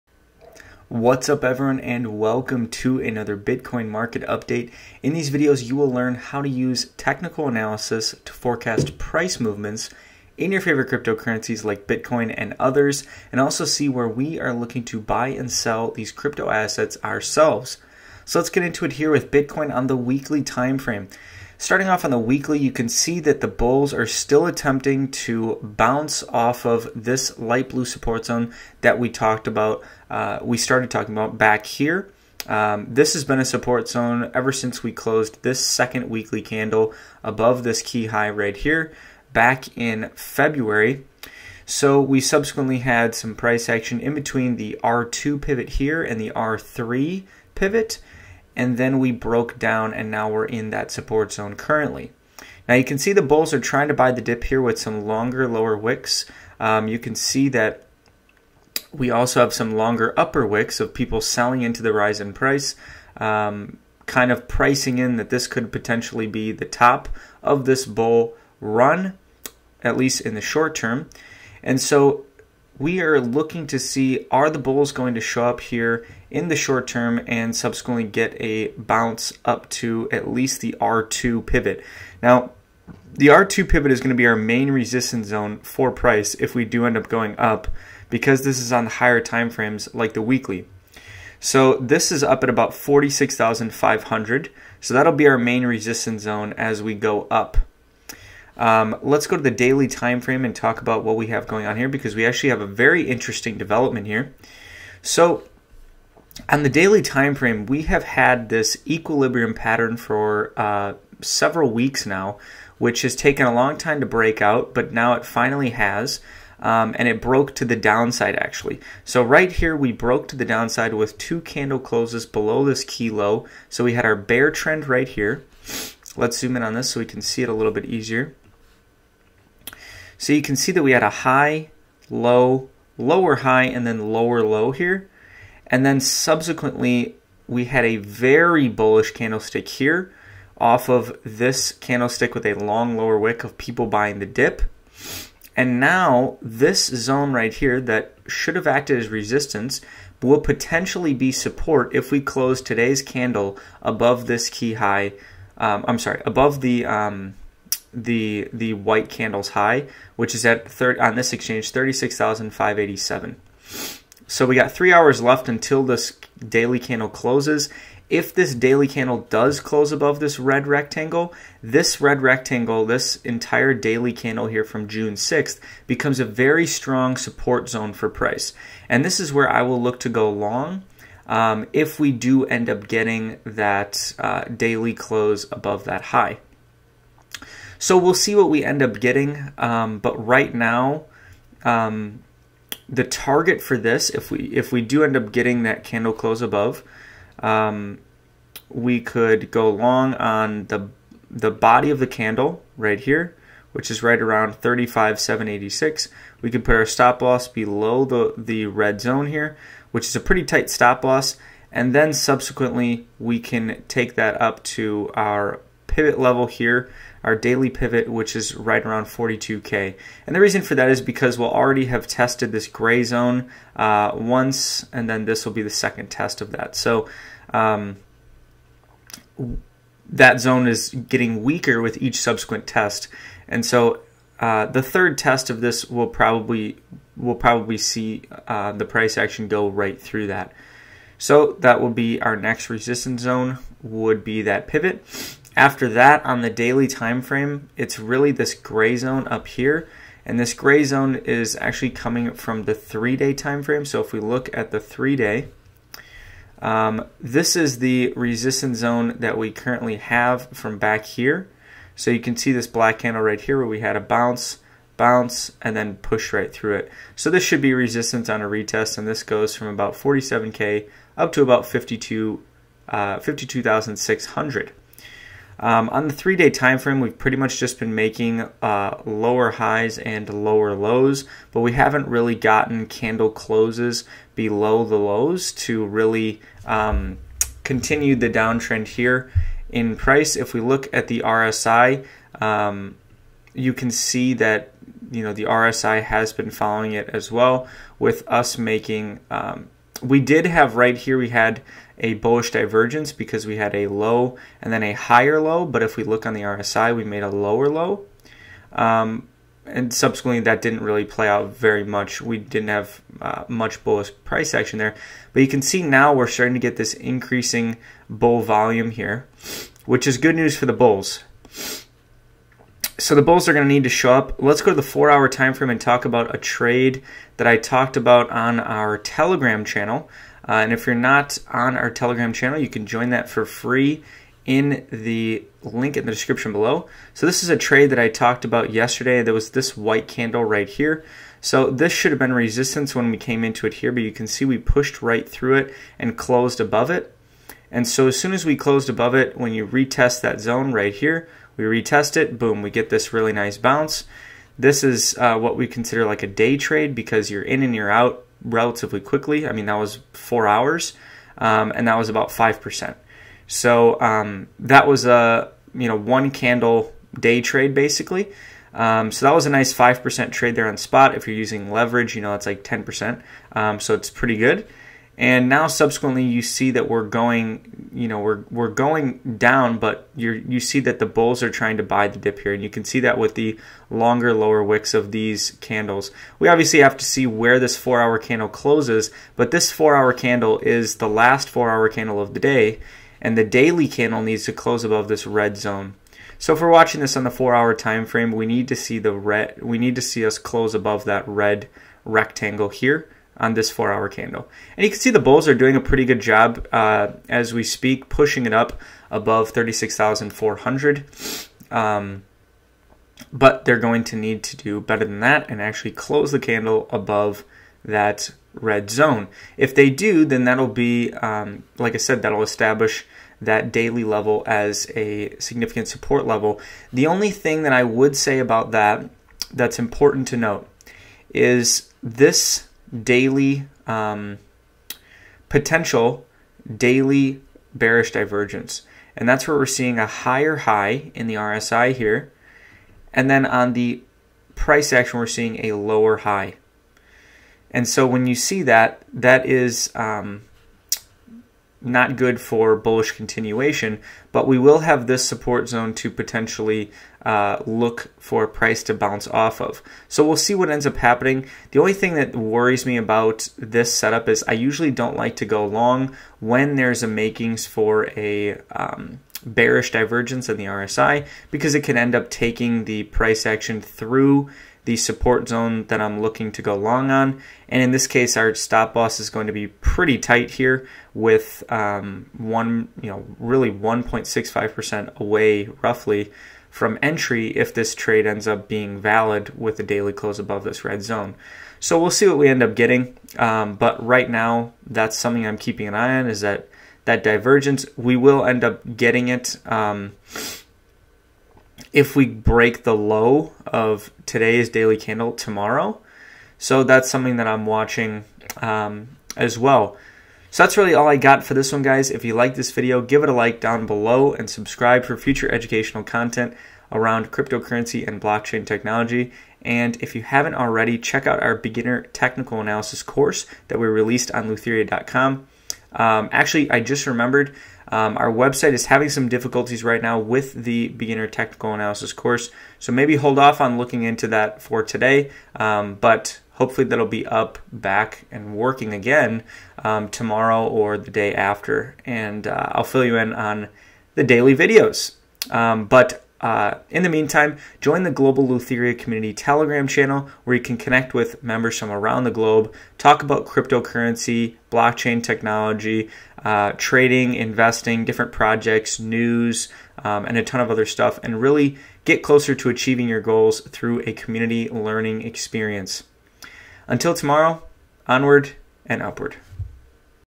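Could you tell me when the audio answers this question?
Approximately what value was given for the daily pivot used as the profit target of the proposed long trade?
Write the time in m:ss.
3:39.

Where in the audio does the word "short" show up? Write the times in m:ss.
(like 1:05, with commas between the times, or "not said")
1:10, 1:16.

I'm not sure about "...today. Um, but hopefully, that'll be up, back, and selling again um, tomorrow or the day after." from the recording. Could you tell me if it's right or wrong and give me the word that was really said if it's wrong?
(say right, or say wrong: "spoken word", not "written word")
wrong: "working", not "selling".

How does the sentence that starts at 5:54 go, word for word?
This is uh, what we consider like a day trade because you're in and you're out relatively quickly.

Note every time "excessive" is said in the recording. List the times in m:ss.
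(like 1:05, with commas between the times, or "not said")
not said.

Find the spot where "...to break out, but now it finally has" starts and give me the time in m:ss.
1:53.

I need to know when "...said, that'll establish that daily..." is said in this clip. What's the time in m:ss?
7:01.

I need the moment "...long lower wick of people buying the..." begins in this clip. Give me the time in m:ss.
2:22.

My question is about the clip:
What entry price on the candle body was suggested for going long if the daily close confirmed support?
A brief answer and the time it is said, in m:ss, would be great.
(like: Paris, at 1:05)
35,786, at 3:24.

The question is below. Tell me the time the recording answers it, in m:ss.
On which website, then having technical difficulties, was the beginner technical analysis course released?
8:44.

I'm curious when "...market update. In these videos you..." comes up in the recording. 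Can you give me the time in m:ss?
0:03.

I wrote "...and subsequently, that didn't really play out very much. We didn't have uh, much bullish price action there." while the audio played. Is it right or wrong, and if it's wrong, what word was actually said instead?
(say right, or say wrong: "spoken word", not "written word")
right.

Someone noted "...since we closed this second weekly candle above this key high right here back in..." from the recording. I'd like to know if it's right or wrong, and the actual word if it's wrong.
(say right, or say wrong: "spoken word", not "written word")
right.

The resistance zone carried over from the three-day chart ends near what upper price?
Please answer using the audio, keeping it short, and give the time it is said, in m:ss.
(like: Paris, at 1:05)
52,600, at 4:33.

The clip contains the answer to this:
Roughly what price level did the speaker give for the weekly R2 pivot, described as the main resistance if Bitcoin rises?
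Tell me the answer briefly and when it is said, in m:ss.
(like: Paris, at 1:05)
46,500, at 1:32.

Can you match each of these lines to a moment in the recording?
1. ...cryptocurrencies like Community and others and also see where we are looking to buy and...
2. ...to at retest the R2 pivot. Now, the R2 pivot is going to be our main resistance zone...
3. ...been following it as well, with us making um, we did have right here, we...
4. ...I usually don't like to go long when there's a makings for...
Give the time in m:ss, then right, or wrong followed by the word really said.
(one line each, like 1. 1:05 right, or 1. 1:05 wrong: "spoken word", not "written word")
1. 0:10 wrong: "Bitcoin", not "Community"
2. 1:19 wrong: "least", not "retest"
3. 4:56 right
4. 7:44 right.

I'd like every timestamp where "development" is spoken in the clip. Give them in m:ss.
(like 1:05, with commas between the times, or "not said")
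1:43.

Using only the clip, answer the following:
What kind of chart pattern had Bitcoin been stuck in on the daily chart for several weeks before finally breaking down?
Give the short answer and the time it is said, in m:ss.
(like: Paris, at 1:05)
Equilibrium pattern, at 1:48.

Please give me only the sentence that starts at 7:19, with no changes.
And that's where we're seeing a higher high in the RSI here.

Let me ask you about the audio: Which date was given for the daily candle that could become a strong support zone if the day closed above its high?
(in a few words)
June 6th.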